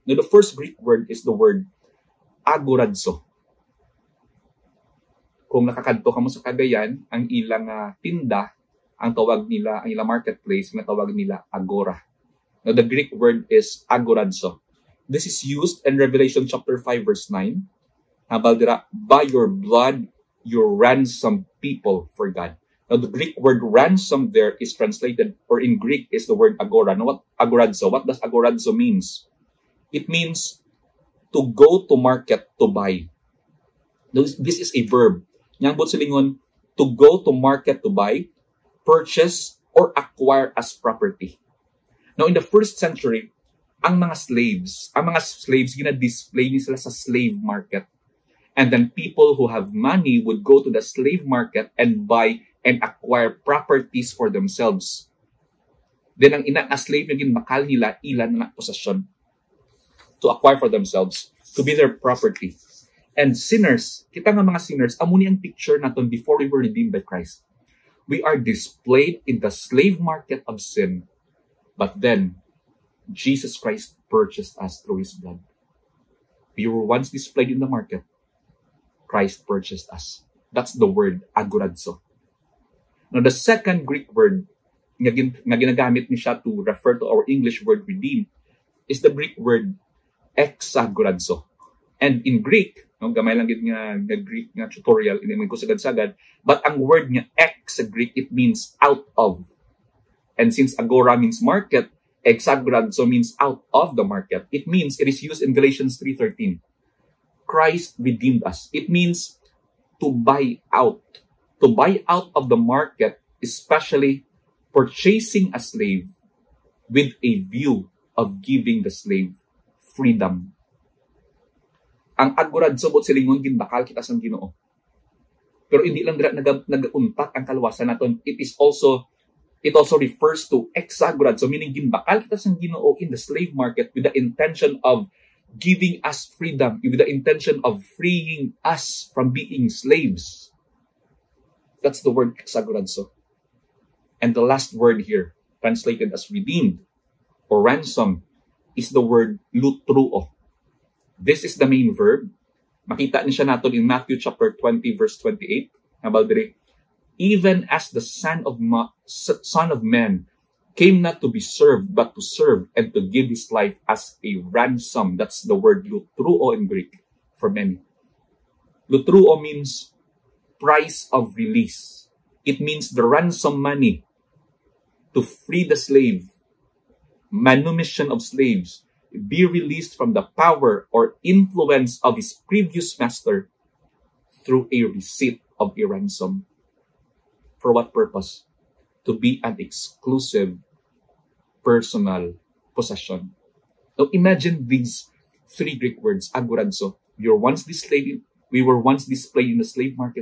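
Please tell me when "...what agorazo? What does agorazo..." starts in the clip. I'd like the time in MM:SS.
00:27.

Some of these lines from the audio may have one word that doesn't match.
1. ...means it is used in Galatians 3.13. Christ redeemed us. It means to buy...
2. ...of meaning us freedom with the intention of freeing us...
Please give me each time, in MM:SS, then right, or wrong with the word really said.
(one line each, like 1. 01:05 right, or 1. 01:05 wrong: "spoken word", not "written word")
1. 01:44 right
2. 02:14 wrong: "giving", not "meaning".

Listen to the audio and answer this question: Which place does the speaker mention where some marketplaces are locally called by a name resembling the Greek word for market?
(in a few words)
Cagayan.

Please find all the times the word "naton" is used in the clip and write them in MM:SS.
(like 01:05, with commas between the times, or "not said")
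01:05, 02:07.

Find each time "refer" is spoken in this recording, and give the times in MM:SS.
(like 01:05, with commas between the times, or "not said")
01:26, 02:09.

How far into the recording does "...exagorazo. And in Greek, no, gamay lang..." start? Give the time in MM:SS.
01:30.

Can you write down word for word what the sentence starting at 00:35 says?
Nyambot silingon, to go to market to buy, purchase, or acquire as property.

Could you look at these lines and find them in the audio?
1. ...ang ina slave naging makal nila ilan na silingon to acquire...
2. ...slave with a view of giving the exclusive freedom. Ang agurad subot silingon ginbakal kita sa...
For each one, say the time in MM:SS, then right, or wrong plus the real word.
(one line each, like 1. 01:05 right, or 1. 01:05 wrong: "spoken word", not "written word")
1. 00:56 wrong: "posesyon", not "silingon"
2. 01:55 wrong: "slave", not "exclusive".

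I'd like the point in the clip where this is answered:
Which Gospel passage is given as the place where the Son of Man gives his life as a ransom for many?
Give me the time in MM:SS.
02:33.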